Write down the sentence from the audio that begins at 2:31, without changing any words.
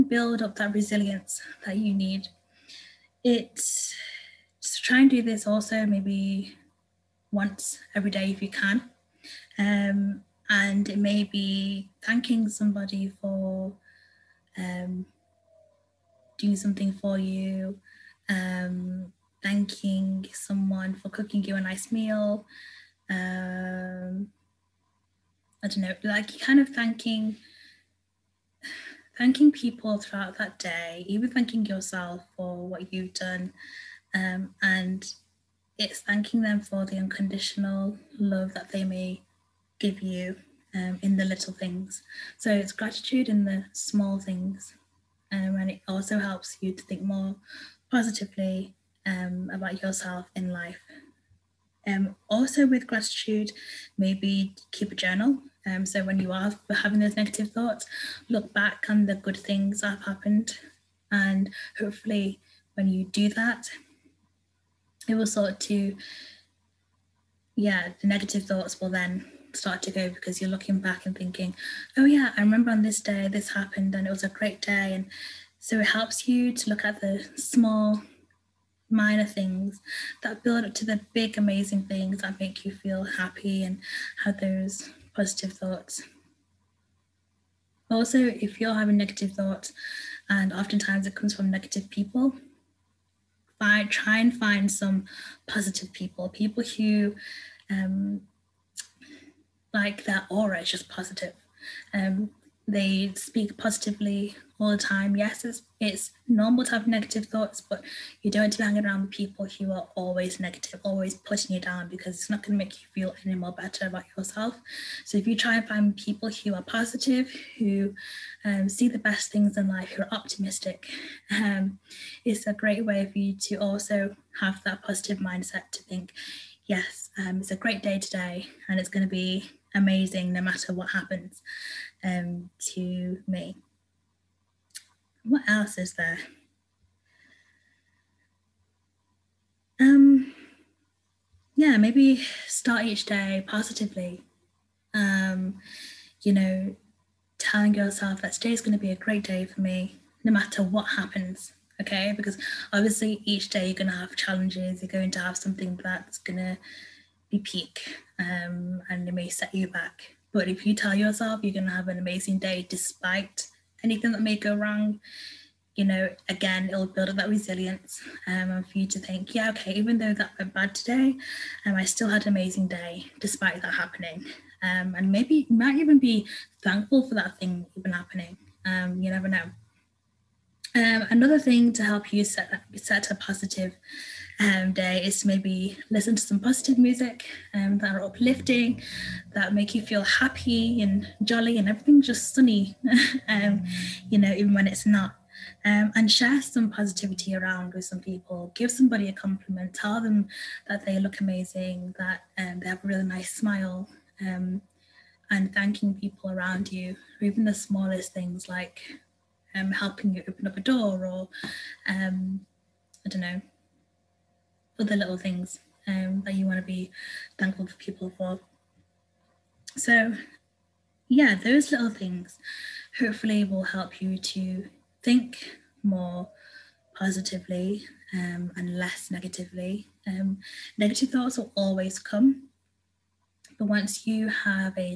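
Okay, because obviously each day you're going to have challenges.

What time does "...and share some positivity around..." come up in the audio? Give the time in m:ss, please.
3:15.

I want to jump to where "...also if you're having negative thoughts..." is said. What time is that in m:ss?
1:27.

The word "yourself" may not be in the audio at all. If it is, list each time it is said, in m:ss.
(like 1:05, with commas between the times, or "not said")
0:31, 0:49, 1:54, 2:27, 2:40.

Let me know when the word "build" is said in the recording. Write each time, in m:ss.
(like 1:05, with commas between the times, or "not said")
0:00, 1:20, 2:46.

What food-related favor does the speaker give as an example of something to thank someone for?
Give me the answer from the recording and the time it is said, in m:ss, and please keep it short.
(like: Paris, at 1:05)
Cooking you a nice meal, at 0:21.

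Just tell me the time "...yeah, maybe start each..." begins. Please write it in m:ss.
2:21.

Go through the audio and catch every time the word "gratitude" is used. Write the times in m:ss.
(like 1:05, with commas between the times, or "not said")
0:42, 0:52.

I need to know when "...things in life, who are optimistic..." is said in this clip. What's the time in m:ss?
1:59.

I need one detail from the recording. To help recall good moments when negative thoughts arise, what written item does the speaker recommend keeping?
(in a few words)
A journal.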